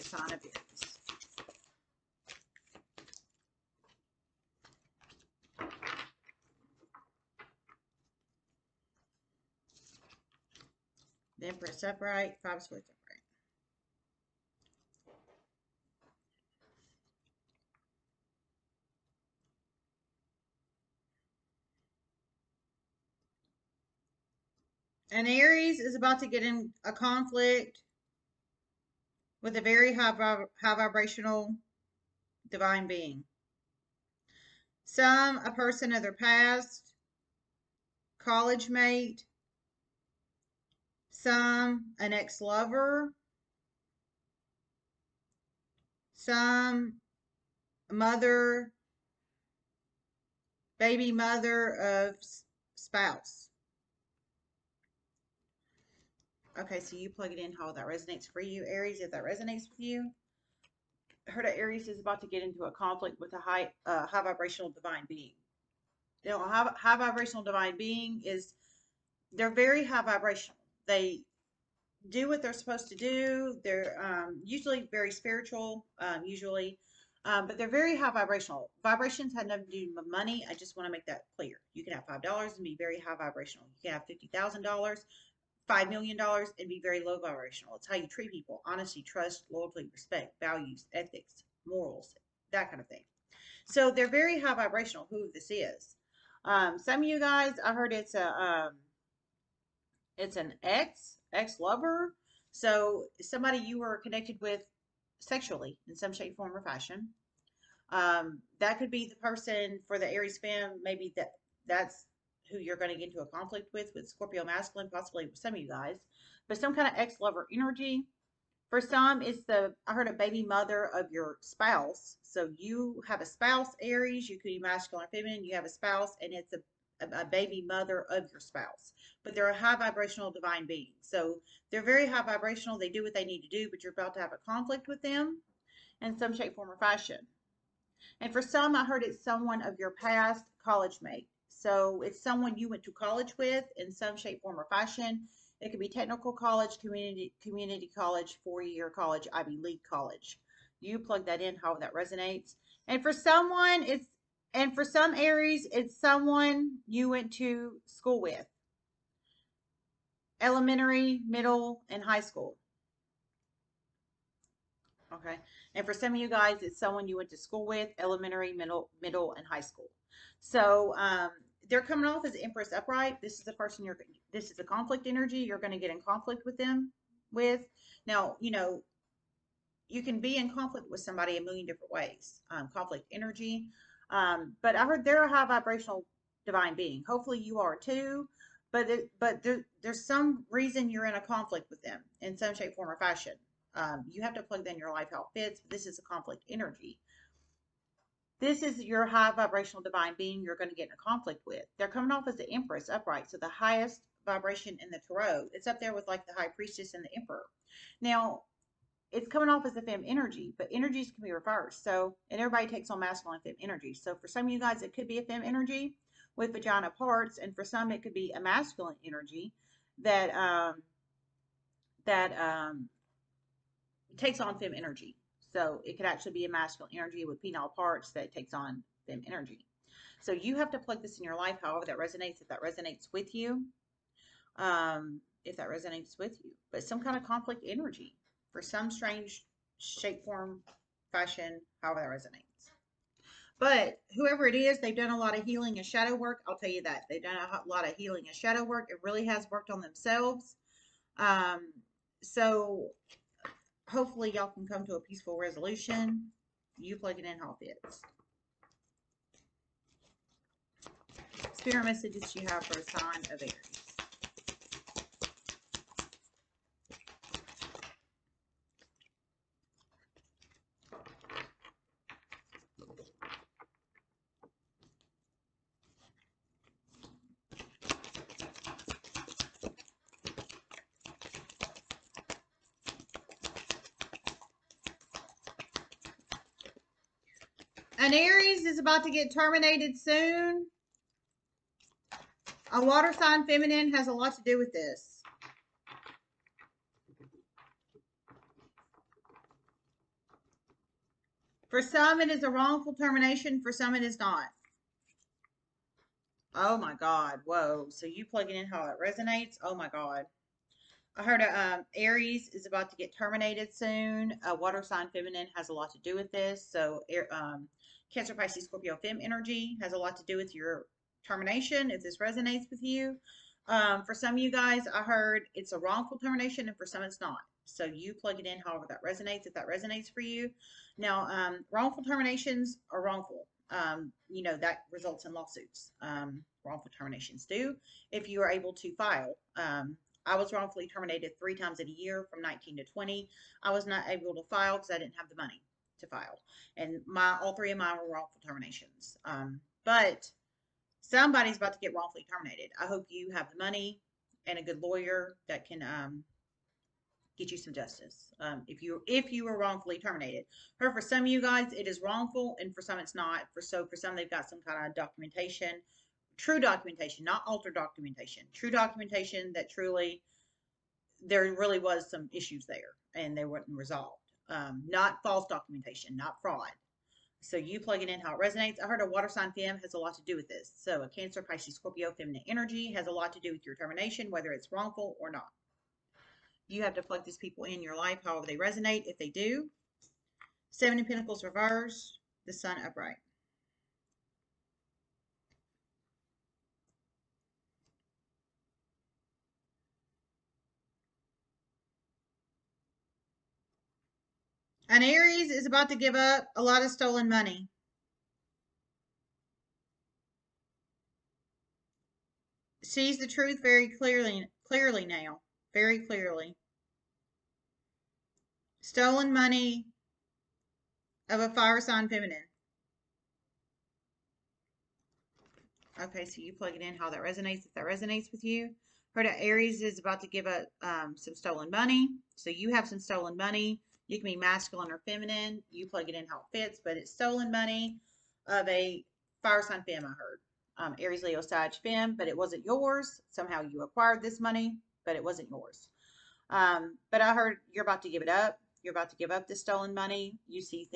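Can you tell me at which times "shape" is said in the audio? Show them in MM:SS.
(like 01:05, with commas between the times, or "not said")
01:46, 02:16, 02:24, 03:12, 03:59.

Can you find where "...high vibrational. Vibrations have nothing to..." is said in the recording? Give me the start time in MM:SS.
01:17.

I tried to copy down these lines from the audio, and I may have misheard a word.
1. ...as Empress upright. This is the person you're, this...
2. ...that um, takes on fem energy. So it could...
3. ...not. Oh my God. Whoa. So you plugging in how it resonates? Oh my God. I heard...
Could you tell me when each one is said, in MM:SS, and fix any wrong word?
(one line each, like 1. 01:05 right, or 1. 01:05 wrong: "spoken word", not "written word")
1. 02:52 right
2. 03:42 right
3. 05:04 right.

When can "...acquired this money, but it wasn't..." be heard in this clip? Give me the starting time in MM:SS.
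07:23.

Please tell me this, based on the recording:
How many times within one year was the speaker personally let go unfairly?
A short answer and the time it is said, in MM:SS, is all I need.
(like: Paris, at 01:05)
3, at 05:41.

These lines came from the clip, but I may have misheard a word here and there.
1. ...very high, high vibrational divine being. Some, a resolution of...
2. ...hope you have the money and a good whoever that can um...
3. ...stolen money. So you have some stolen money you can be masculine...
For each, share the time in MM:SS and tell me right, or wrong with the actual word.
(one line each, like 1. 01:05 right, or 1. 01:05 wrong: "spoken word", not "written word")
1. 00:29 wrong: "person", not "resolution"
2. 05:52 wrong: "lawyer", not "whoever"
3. 07:11 right.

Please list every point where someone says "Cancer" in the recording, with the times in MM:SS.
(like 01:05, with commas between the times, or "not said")
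05:18, 06:21.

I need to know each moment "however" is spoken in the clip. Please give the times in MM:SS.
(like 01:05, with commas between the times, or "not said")
03:51, 04:01, 05:28, 06:28.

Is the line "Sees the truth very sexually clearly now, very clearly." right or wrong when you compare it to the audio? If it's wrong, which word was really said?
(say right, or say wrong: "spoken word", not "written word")
wrong: "clearly", not "sexually".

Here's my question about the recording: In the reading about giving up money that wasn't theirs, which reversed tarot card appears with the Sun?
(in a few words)
Seven of Pentacles.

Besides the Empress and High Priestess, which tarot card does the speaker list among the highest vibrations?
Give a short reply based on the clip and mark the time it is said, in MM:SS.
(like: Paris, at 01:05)
Emperor, at 03:27.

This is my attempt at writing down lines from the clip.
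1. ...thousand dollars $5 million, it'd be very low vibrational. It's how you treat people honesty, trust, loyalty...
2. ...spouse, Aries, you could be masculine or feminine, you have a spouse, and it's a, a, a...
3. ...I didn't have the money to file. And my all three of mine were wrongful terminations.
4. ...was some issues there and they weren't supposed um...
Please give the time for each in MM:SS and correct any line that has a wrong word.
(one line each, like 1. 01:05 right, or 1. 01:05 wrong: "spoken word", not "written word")
1. 01:24 right
2. 02:03 right
3. 05:44 right
4. 06:11 wrong: "resolved", not "supposed".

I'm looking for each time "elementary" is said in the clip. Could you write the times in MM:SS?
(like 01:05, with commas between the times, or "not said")
02:40, 02:47.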